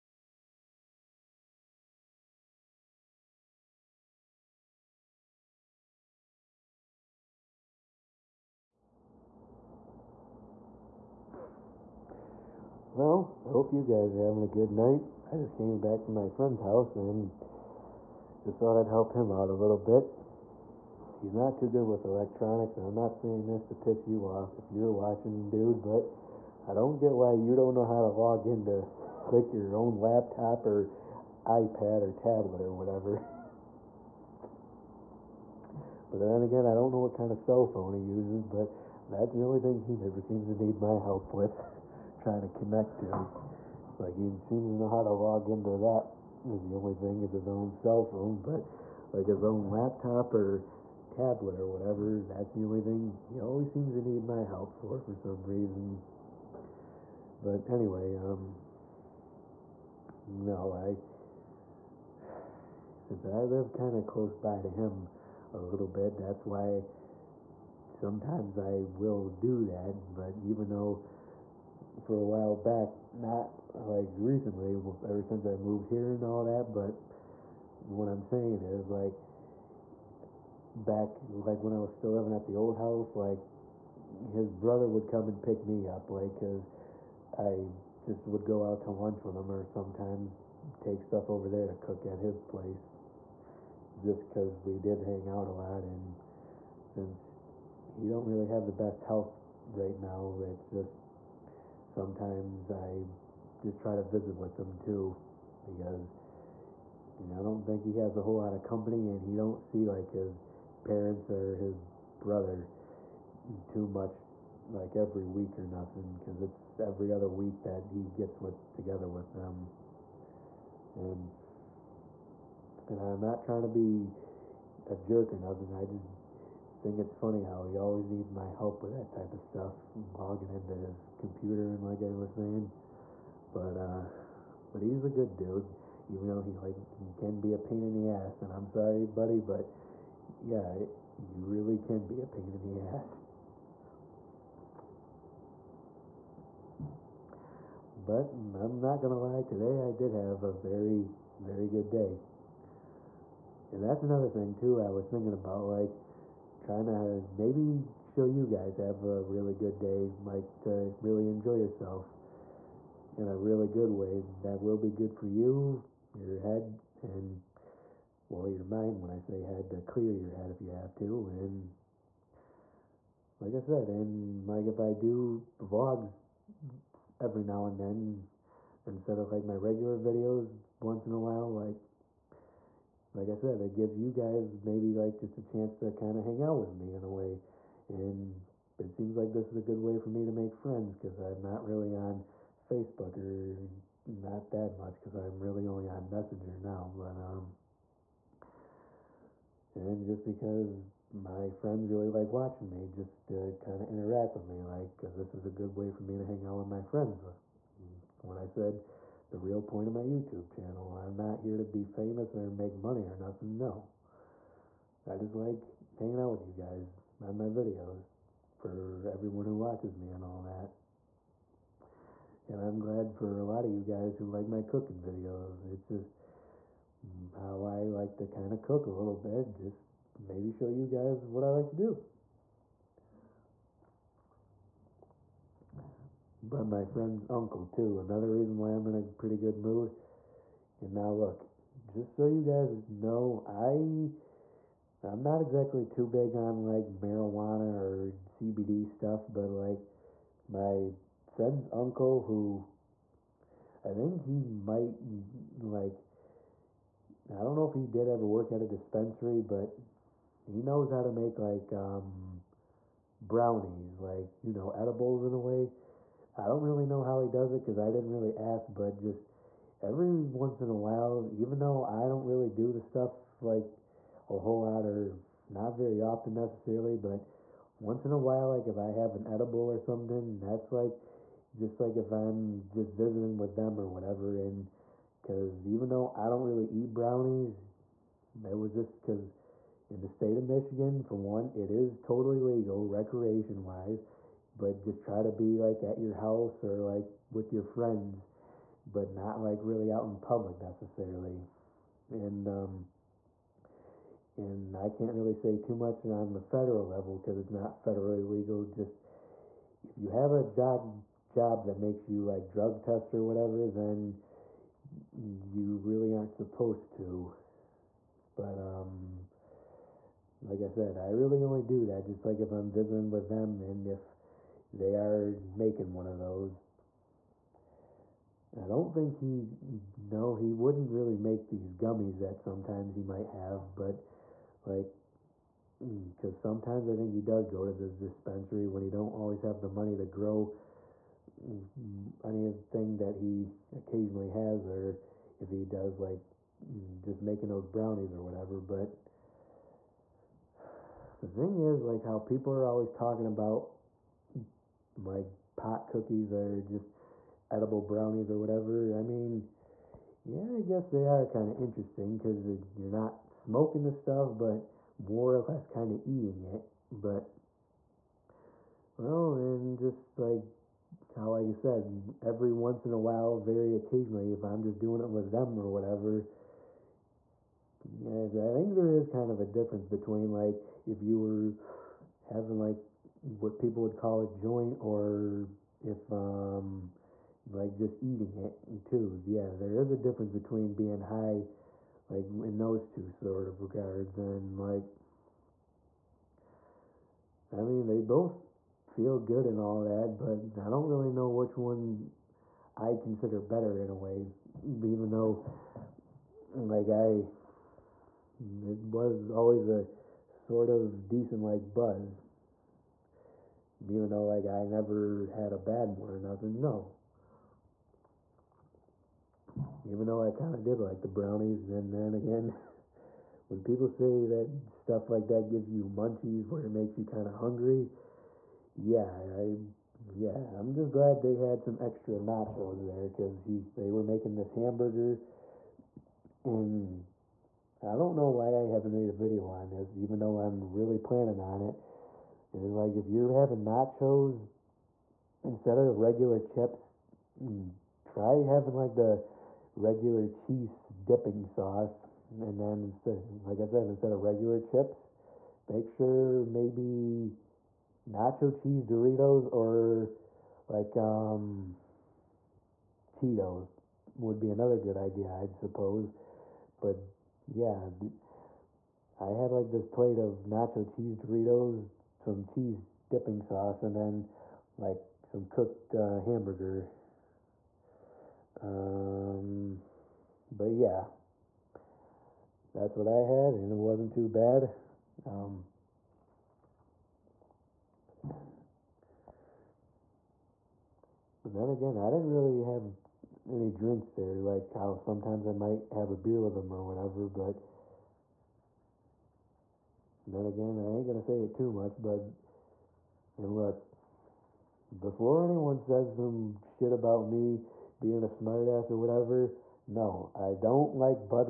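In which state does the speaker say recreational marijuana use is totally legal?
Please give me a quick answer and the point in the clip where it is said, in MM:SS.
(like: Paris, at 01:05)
Michigan, at 04:50.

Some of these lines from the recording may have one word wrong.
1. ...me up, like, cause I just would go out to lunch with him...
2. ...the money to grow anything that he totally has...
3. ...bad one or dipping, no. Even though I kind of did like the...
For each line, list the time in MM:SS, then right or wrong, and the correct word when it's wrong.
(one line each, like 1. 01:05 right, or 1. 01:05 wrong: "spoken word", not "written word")
1. 01:25 right
2. 05:39 wrong: "occasionally", not "totally"
3. 06:55 wrong: "nothing", not "dipping".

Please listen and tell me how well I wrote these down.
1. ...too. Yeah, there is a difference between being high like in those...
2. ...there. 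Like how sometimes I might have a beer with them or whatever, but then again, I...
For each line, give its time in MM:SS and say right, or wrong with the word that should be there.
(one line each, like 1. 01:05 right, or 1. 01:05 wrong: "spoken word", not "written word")
1. 06:28 right
2. 08:14 right.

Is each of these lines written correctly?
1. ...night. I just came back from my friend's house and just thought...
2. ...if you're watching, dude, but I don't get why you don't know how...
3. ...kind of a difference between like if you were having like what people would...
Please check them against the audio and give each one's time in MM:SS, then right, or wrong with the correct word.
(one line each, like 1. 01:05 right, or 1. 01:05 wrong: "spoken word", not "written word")
1. 00:14 right
2. 00:24 right
3. 06:19 right.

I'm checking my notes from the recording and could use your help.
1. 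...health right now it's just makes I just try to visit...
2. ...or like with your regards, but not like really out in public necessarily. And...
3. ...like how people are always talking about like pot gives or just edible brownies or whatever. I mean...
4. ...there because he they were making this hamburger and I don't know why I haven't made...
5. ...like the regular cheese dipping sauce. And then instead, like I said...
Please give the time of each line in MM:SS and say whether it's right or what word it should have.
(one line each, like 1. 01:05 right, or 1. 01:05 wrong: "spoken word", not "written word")
1. 01:39 wrong: "sometimes", not "makes"
2. 04:56 wrong: "friends", not "regards"
3. 05:51 wrong: "cookies", not "gives"
4. 07:12 right
5. 07:28 right.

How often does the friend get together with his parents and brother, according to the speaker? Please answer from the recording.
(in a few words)
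every other week.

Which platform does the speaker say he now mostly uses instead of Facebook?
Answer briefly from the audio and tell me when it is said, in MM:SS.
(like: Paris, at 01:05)
Messenger, at 03:16.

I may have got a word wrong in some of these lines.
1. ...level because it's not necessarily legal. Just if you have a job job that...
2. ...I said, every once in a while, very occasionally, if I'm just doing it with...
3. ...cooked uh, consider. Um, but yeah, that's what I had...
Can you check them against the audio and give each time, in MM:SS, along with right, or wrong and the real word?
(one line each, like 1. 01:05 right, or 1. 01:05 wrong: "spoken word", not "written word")
1. 05:06 wrong: "federally", not "necessarily"
2. 06:11 right
3. 07:55 wrong: "hamburger", not "consider".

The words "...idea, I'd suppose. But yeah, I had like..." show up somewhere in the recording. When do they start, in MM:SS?
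07:44.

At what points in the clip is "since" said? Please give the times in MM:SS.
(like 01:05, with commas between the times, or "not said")
01:03, 01:15, 01:36.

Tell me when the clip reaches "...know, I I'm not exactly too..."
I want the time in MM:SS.
04:02.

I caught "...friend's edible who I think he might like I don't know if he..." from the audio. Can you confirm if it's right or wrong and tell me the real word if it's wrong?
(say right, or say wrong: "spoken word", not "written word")
wrong: "uncle", not "edible".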